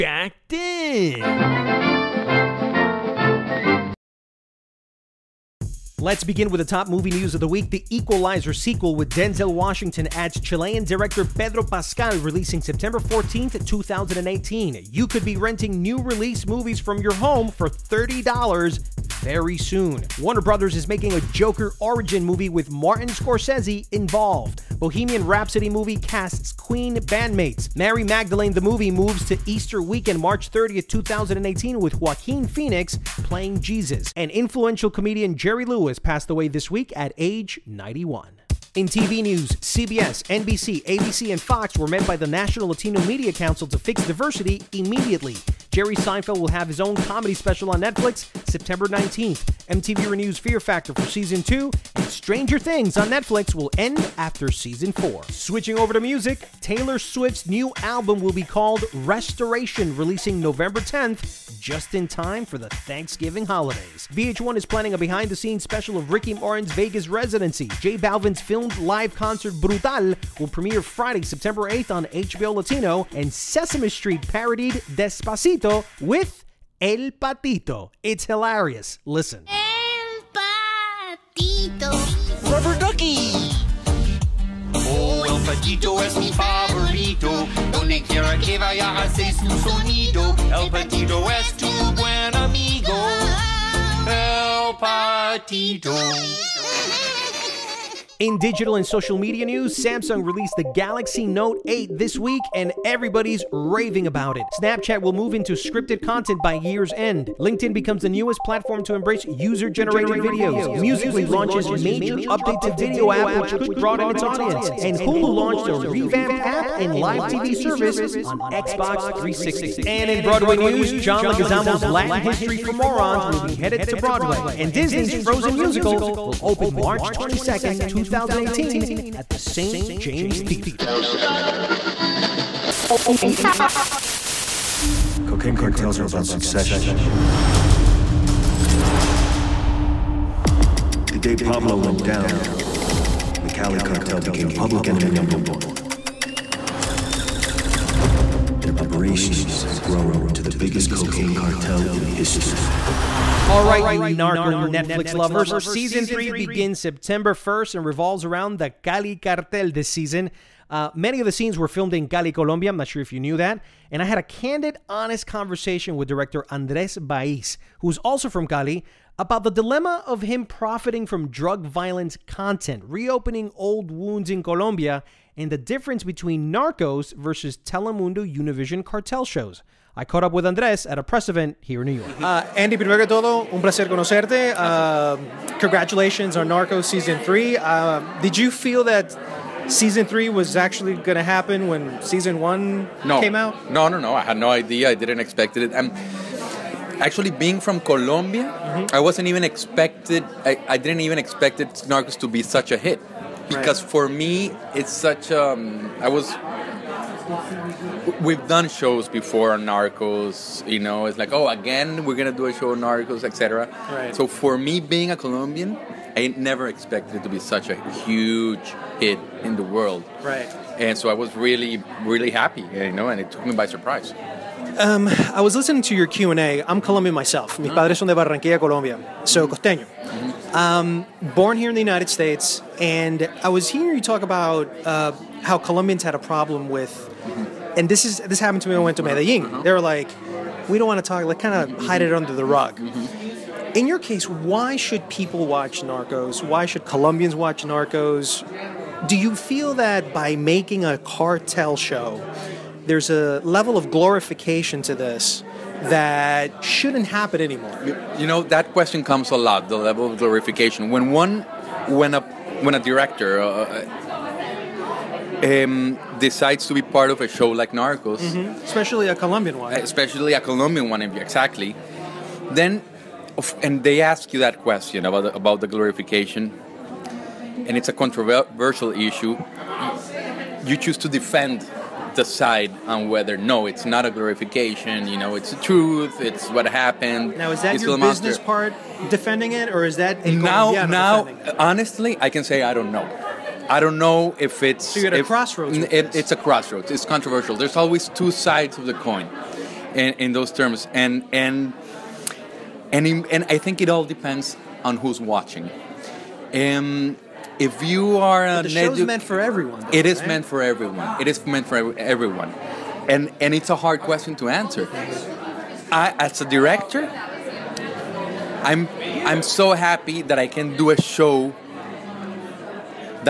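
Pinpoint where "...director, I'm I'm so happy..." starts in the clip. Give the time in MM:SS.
05:16.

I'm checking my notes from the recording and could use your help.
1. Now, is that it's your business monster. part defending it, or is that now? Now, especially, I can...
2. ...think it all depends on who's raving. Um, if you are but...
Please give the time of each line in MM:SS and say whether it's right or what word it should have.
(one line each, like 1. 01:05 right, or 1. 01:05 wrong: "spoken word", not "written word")
1. 04:47 wrong: "honestly", not "especially"
2. 05:03 wrong: "watching", not "raving".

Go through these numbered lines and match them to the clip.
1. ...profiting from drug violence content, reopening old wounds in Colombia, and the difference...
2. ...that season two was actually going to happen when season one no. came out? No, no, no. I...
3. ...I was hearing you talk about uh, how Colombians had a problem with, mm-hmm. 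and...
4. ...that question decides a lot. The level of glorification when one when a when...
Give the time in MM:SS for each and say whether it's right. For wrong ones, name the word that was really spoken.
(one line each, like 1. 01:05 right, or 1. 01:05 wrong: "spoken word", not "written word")
1. 02:50 right
2. 03:08 wrong: "three", not "two"
3. 03:53 right
4. 04:18 wrong: "comes", not "decides".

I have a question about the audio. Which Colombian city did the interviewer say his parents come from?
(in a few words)
Barranquilla.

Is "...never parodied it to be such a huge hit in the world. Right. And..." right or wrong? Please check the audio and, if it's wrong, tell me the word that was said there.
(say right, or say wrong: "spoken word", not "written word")
wrong: "expected", not "parodied".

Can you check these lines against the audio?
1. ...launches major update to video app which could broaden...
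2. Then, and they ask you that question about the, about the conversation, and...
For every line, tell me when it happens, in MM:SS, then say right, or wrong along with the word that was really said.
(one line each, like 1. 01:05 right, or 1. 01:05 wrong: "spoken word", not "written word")
1. 01:51 right
2. 04:32 wrong: "glorification", not "conversation".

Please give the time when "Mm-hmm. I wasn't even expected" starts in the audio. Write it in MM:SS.
03:18.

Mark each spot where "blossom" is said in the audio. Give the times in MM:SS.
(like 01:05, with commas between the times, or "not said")
not said.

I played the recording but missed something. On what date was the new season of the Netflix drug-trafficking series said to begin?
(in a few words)
September 1st.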